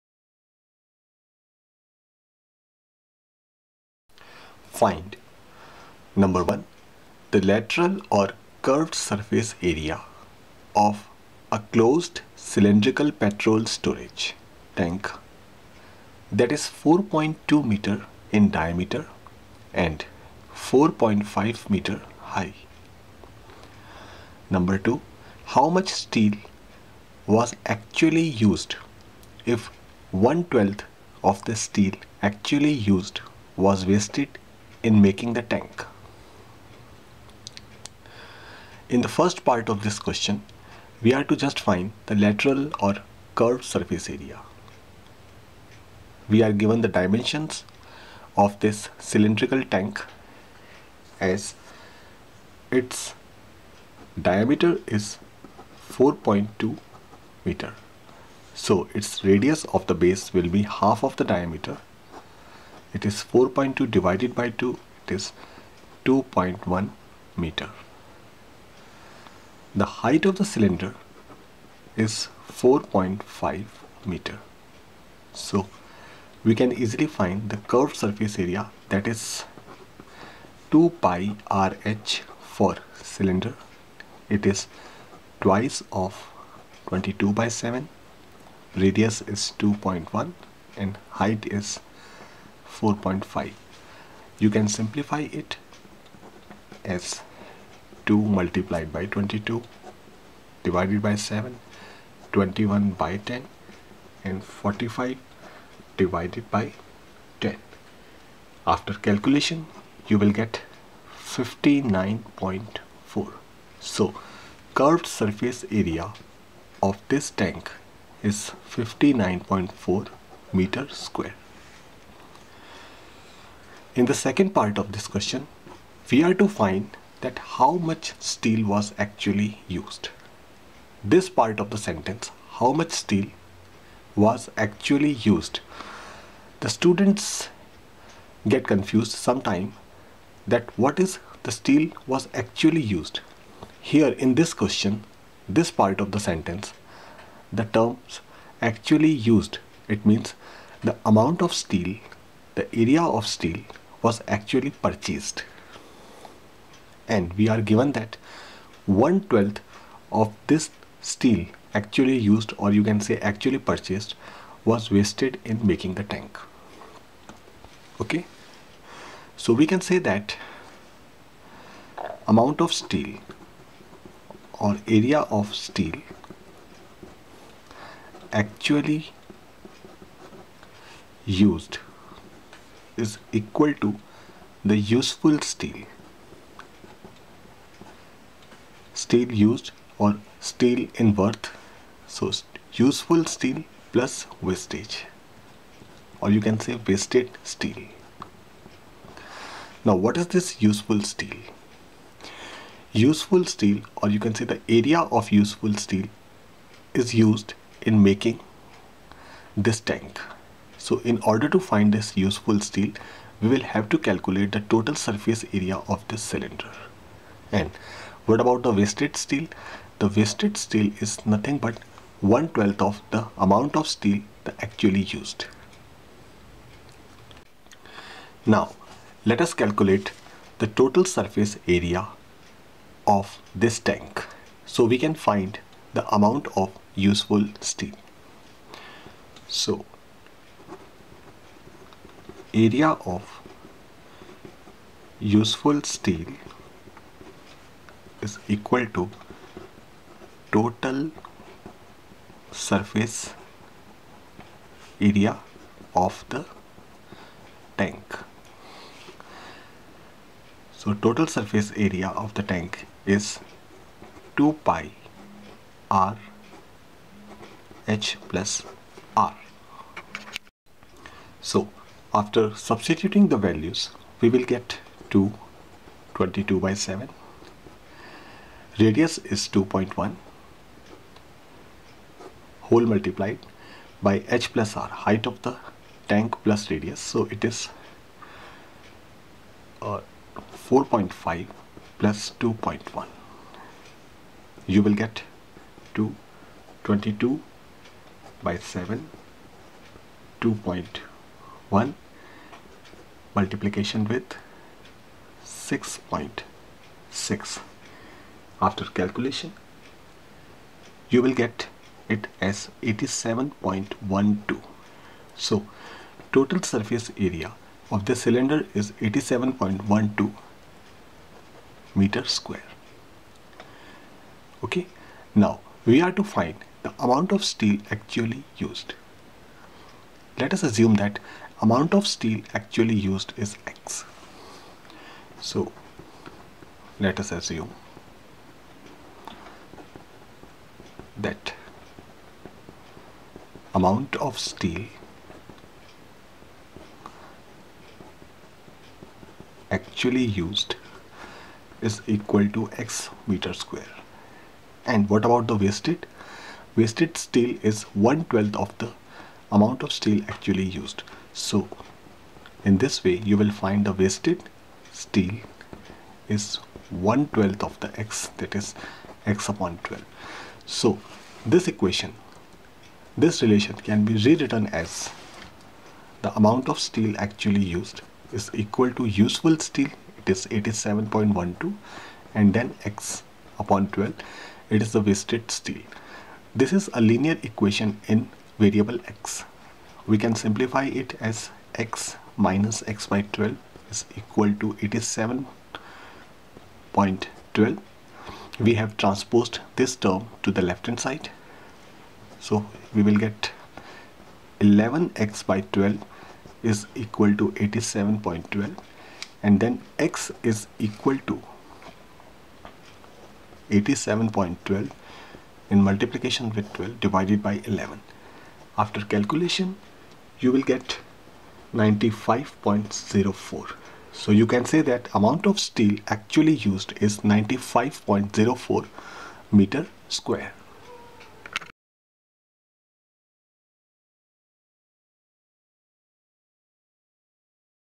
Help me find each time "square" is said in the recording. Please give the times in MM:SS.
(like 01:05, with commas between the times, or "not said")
02:01, 05:22, 05:53, 07:10.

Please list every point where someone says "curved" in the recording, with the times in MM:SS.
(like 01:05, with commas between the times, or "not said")
00:08, 00:43, 01:17, 01:54.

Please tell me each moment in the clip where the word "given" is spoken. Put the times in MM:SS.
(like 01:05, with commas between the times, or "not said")
00:46, 02:37.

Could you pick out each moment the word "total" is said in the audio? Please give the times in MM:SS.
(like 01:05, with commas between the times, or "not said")
03:34, 03:50, 04:10, 04:20, 05:16.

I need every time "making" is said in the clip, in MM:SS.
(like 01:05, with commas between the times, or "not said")
00:35, 02:45, 03:28.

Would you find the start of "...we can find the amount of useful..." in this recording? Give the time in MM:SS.
03:54.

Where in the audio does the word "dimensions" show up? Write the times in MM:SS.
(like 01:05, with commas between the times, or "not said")
00:46.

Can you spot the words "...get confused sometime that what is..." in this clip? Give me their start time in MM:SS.
02:18.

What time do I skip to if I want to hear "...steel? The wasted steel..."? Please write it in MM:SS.
03:39.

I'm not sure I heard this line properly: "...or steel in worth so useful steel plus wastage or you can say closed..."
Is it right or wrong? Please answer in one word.
wrong.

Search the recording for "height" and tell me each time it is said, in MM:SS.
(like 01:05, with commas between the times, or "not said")
01:10, 01:31, 04:44.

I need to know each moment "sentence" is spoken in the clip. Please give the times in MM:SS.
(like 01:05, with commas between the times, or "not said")
02:11, 02:26.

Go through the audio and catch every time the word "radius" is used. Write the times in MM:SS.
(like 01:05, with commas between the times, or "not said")
00:59, 01:28, 04:38, 04:46.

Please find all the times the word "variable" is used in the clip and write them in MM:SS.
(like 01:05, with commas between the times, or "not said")
06:28.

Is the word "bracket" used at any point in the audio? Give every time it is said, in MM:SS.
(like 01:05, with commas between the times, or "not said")
not said.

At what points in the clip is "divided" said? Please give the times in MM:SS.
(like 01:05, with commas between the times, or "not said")
01:03, 01:40, 01:46, 06:57.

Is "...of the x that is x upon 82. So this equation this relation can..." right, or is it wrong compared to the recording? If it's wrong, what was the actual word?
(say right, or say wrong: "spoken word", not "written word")
wrong: "12", not "82".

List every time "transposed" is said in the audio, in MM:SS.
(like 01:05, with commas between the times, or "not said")
06:39.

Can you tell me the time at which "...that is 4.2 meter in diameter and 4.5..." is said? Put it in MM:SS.
00:16.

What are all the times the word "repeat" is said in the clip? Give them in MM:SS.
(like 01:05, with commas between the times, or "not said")
not said.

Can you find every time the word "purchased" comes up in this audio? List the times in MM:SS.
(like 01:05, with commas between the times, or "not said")
02:34, 02:43.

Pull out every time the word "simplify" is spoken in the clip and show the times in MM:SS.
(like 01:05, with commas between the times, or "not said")
01:34, 06:30.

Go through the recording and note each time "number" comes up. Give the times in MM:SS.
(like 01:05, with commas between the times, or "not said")
00:06, 00:24.